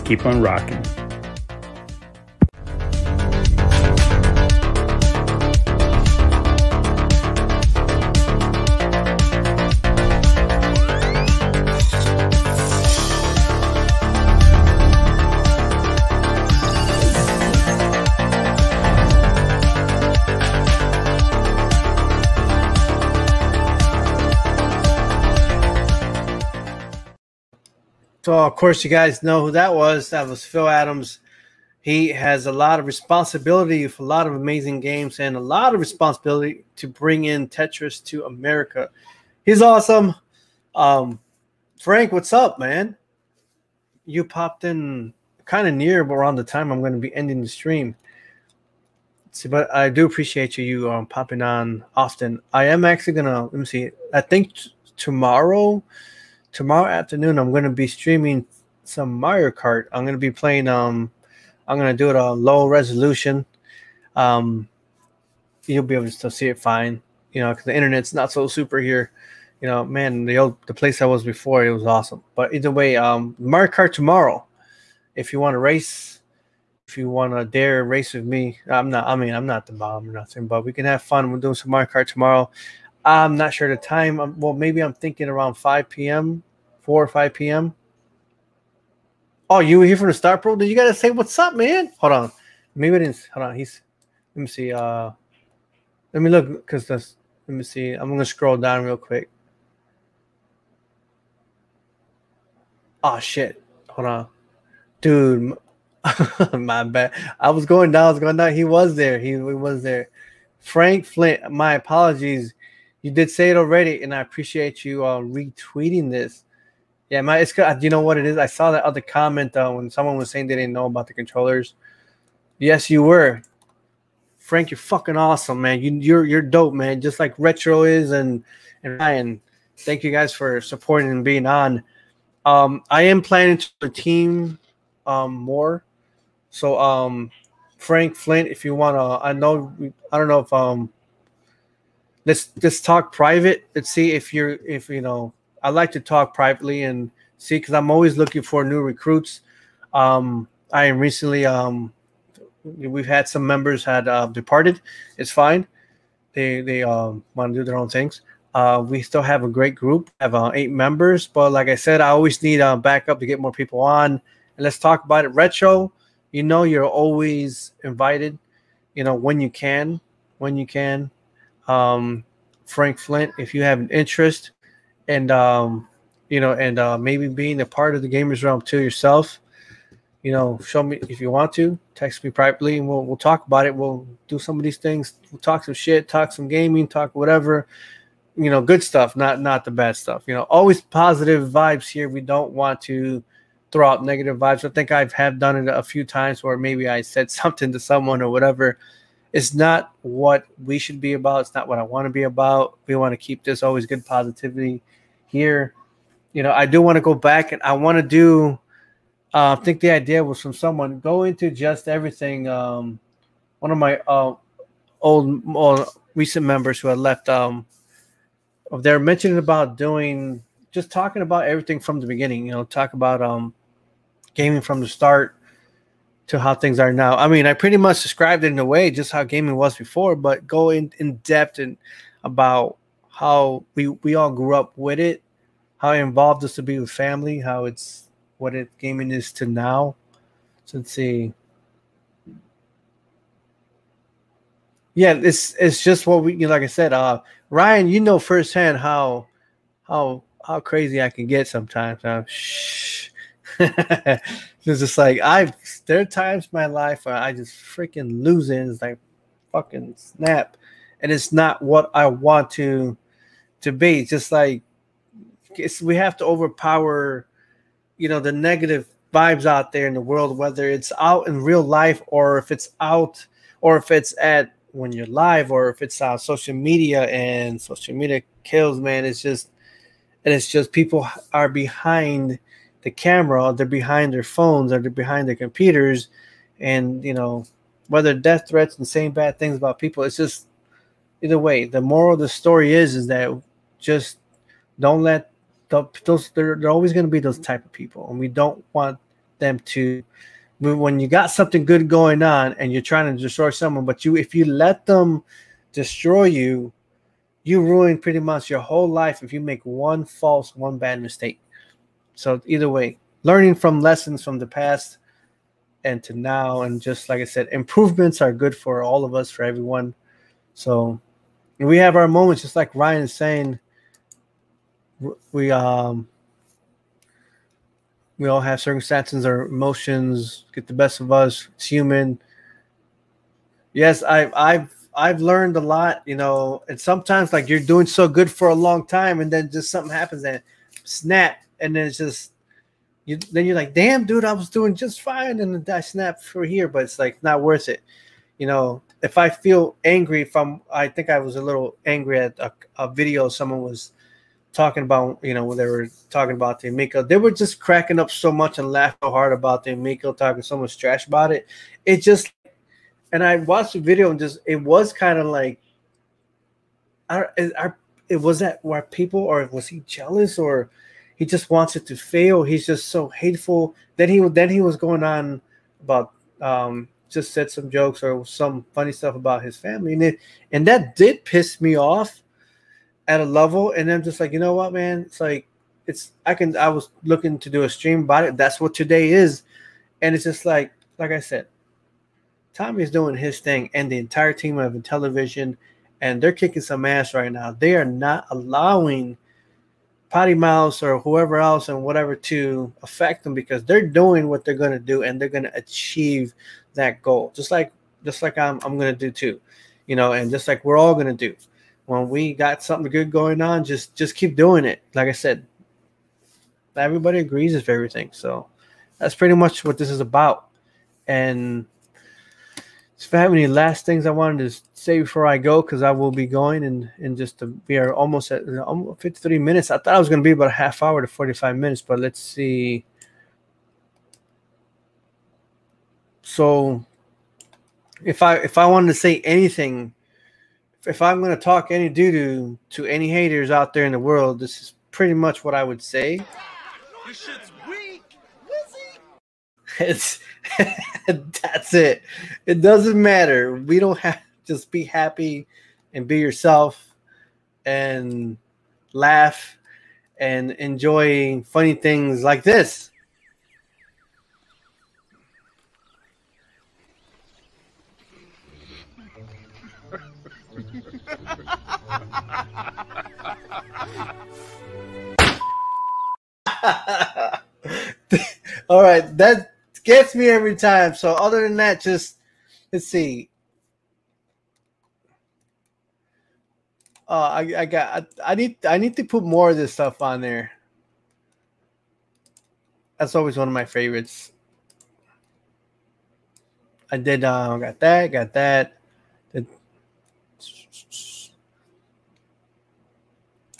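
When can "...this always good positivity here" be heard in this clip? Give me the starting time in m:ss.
3:23.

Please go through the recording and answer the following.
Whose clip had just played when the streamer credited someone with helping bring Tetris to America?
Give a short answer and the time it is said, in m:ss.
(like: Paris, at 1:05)
Phil Adams, at 0:30.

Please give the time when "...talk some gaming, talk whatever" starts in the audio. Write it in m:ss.
3:06.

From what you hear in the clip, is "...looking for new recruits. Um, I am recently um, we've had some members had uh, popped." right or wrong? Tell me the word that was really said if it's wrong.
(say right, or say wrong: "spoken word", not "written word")
wrong: "departed", not "popped".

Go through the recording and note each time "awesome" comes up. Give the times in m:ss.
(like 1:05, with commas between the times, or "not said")
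0:39, 1:11, 2:05.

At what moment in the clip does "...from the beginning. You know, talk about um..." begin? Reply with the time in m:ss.
3:41.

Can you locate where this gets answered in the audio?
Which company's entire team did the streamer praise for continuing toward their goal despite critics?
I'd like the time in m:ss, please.
6:34.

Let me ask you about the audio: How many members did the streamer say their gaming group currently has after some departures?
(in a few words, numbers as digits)
8.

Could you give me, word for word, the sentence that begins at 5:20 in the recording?
So we have our moments, just like Ryan is saying.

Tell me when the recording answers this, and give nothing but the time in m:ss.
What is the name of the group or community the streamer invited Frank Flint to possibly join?
2:58.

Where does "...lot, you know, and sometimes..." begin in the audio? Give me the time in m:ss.
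5:35.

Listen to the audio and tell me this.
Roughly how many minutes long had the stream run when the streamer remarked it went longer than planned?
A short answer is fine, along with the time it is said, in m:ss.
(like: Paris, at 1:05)
53, at 7:09.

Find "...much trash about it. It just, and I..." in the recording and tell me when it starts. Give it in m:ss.
6:00.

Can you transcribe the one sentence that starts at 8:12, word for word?
That's always one of my favorites.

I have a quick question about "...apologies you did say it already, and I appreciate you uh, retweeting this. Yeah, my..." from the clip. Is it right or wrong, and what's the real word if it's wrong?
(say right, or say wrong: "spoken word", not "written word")
right.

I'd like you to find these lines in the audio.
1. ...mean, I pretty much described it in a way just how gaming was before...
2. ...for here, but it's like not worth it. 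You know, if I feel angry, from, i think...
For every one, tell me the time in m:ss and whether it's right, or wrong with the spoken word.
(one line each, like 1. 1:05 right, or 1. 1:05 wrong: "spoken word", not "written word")
1. 3:47 right
2. 5:46 right.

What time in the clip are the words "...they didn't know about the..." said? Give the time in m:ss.
2:00.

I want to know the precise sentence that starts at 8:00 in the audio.
So other than that, just let's see.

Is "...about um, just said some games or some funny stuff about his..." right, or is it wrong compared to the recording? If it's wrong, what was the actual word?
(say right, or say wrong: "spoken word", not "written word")
wrong: "jokes", not "games".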